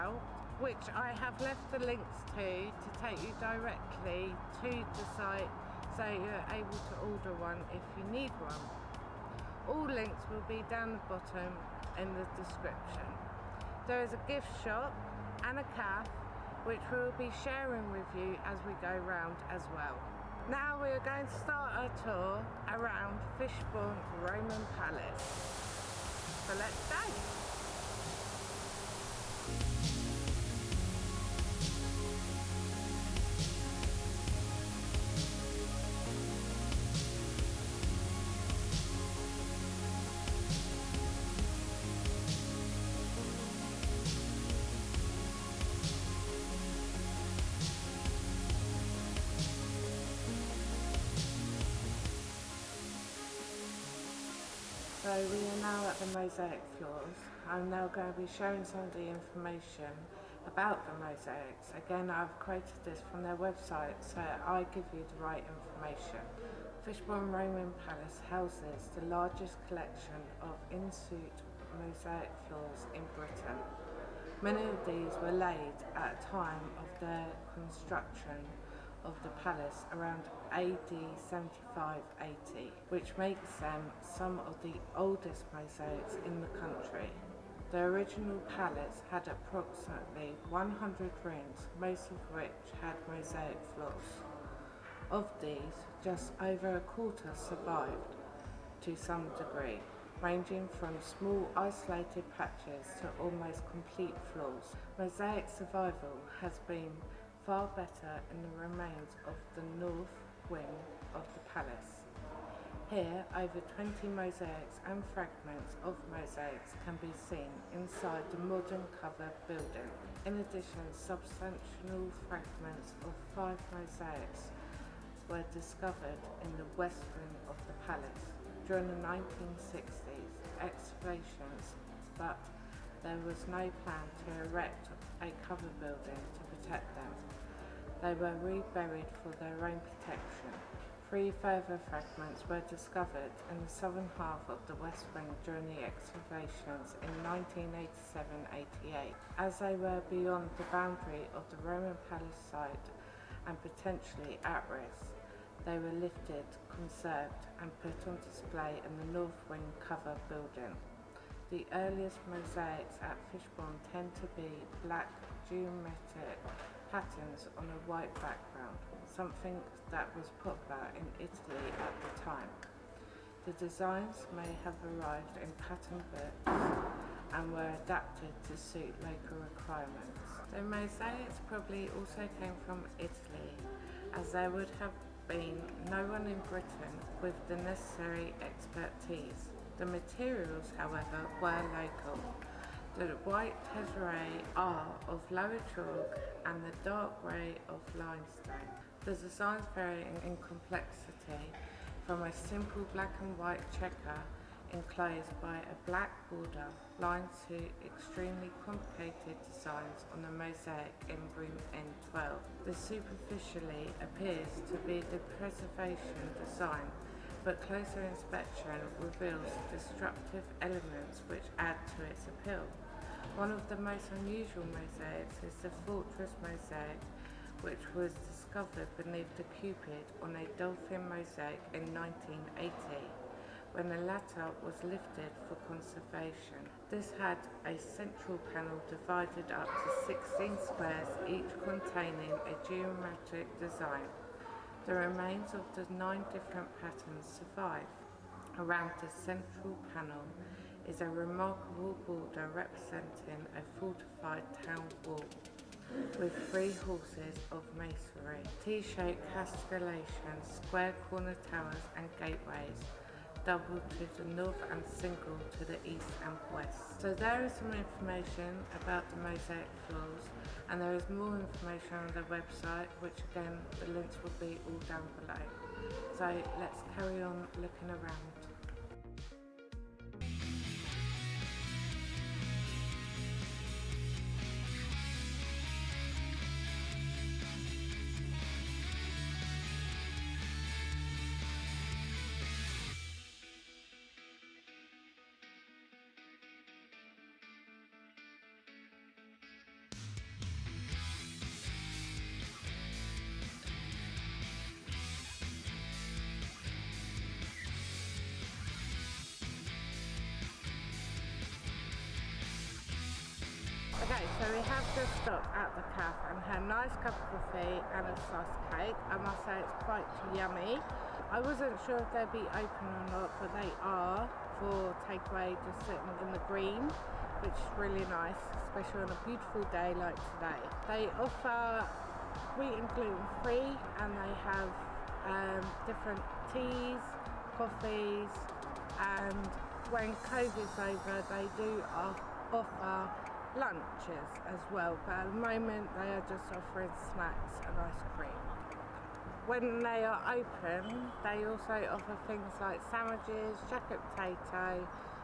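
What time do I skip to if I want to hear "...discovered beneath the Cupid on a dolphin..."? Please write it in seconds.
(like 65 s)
228 s.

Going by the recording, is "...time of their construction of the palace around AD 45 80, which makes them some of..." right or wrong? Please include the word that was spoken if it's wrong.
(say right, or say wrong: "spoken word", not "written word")
wrong: "75", not "45".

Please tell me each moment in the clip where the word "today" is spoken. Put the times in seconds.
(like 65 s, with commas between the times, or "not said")
330 s.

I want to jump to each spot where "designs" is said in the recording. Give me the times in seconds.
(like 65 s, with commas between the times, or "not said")
173 s, 199 s, 209 s, 216 s, 243 s.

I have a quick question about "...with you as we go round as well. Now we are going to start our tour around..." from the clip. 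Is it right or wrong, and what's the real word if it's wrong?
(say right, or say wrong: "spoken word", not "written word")
right.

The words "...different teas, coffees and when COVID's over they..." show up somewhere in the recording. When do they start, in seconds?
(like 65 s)
335 s.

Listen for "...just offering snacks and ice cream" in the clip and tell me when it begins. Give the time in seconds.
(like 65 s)
346 s.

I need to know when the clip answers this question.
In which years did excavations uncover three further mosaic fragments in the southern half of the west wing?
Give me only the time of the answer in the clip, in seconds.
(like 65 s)
148 s.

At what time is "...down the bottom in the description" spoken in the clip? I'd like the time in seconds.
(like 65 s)
10 s.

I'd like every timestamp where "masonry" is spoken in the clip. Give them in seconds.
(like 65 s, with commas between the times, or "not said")
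257 s.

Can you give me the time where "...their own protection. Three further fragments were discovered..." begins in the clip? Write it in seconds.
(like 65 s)
139 s.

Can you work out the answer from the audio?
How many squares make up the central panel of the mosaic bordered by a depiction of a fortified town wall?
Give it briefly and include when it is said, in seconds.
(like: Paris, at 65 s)
16, at 240 s.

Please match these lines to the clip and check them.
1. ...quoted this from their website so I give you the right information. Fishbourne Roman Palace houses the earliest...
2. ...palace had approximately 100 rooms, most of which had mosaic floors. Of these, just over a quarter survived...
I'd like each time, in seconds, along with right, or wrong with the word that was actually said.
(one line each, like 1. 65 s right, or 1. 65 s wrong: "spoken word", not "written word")
1. 62 s wrong: "largest", not "earliest"
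2. 88 s right.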